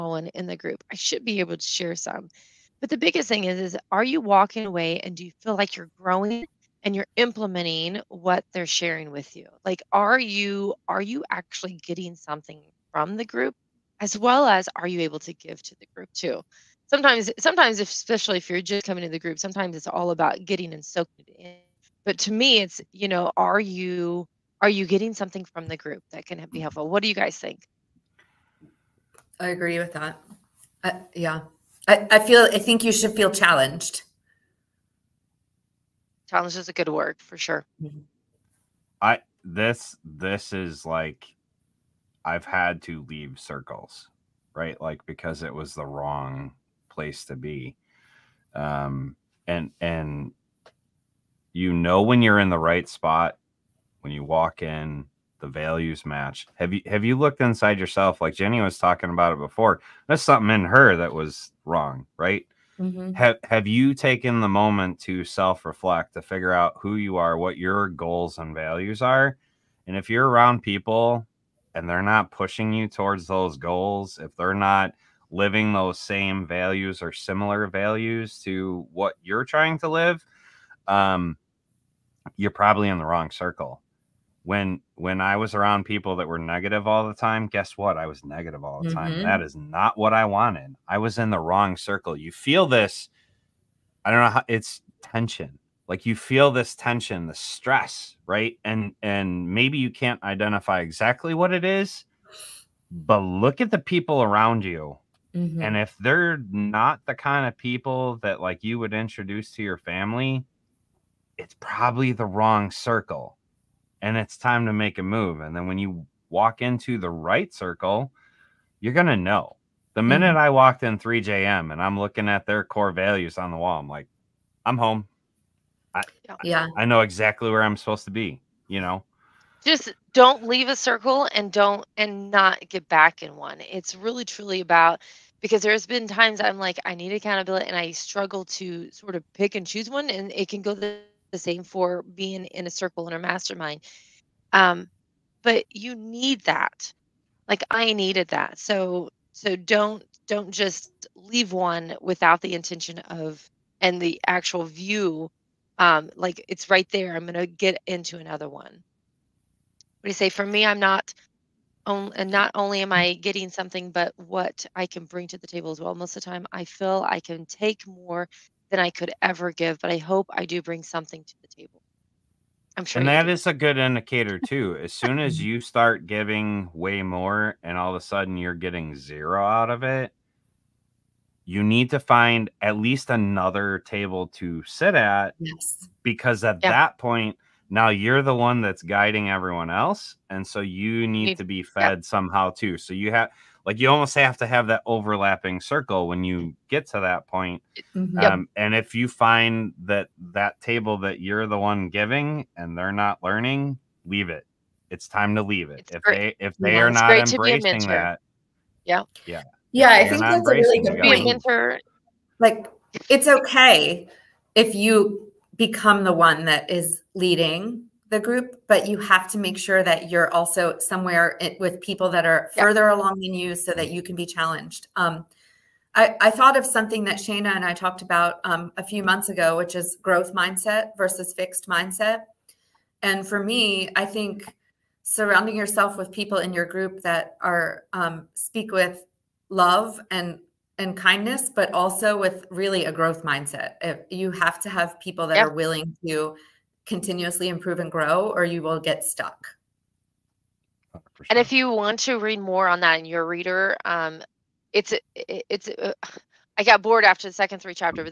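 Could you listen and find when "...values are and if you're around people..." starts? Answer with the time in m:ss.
1:08.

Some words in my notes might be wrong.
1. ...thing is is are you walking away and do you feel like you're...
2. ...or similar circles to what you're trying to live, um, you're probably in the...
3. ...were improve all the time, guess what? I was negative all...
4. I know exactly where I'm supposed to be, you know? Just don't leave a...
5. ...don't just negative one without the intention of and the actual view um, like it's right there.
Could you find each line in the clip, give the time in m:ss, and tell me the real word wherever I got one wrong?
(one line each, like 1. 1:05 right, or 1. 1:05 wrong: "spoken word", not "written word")
1. 0:03 right
2. 1:17 wrong: "values", not "circles"
3. 1:26 wrong: "negative", not "improve"
4. 2:06 right
5. 2:30 wrong: "leave", not "negative".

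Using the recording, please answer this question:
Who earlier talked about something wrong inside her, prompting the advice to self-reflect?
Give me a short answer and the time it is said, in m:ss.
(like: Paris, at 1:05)
Ginny, at 0:58.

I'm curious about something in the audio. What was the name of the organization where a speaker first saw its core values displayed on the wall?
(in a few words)
3JM.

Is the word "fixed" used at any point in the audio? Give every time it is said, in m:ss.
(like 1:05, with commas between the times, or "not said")
3:51.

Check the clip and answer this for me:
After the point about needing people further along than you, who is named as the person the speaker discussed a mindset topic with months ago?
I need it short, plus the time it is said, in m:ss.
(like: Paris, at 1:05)
Shayna, at 3:47.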